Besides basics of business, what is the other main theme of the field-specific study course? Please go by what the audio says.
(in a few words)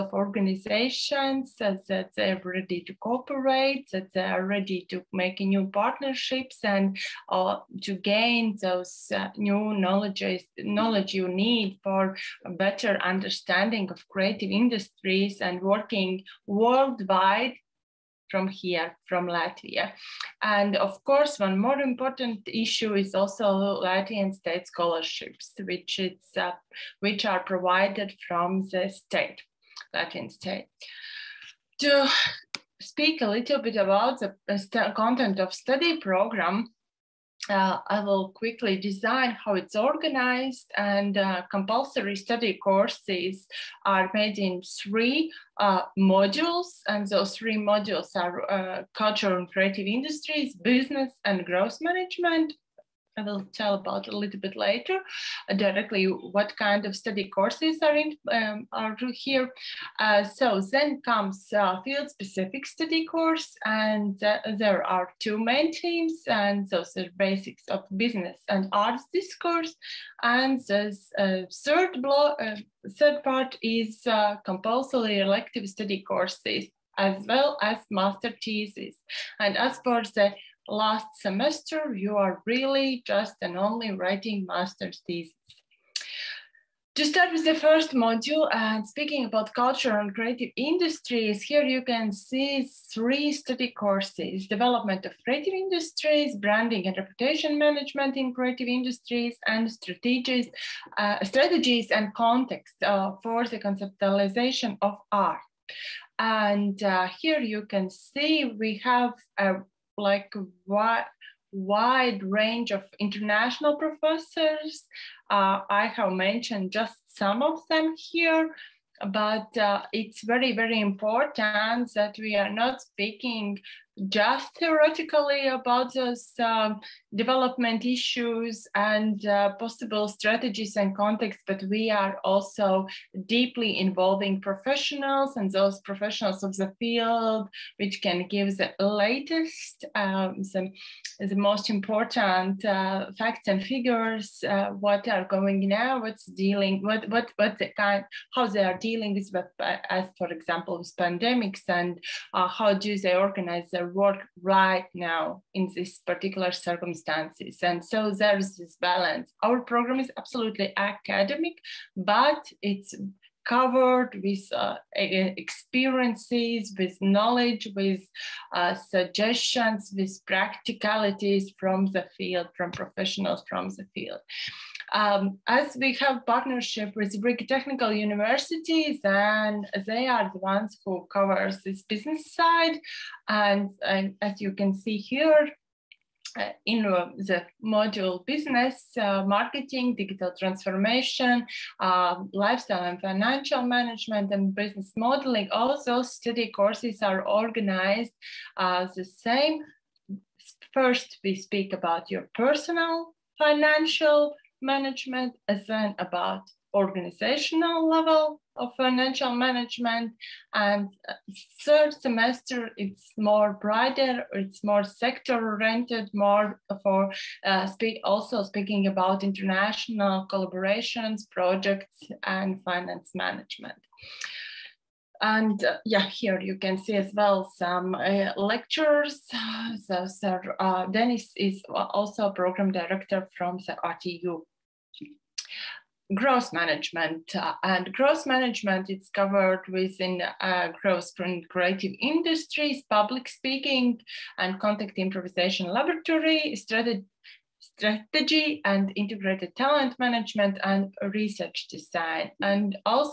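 Arts discourse.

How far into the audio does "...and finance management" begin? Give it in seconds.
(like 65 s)
222 s.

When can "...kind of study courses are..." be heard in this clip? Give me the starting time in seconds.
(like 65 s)
56 s.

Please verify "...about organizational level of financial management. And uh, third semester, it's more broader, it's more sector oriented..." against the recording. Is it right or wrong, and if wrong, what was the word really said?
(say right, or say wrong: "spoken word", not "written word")
right.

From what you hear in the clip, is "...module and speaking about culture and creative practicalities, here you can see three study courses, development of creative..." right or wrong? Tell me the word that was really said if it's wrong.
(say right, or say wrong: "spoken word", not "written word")
wrong: "industries", not "practicalities".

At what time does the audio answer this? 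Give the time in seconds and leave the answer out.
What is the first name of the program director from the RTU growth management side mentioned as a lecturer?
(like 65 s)
230 s.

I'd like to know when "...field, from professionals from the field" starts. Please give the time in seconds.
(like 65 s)
172 s.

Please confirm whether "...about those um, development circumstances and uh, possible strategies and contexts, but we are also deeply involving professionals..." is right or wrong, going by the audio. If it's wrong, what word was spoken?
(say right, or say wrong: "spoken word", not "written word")
wrong: "issues", not "circumstances".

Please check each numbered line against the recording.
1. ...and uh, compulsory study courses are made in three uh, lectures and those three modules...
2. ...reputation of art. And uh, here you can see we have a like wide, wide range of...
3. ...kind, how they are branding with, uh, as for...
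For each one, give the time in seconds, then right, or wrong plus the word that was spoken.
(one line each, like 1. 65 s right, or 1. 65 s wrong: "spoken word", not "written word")
1. 40 s wrong: "modules", not "lectures"
2. 103 s wrong: "conceptualization", not "reputation"
3. 147 s wrong: "dealing", not "branding".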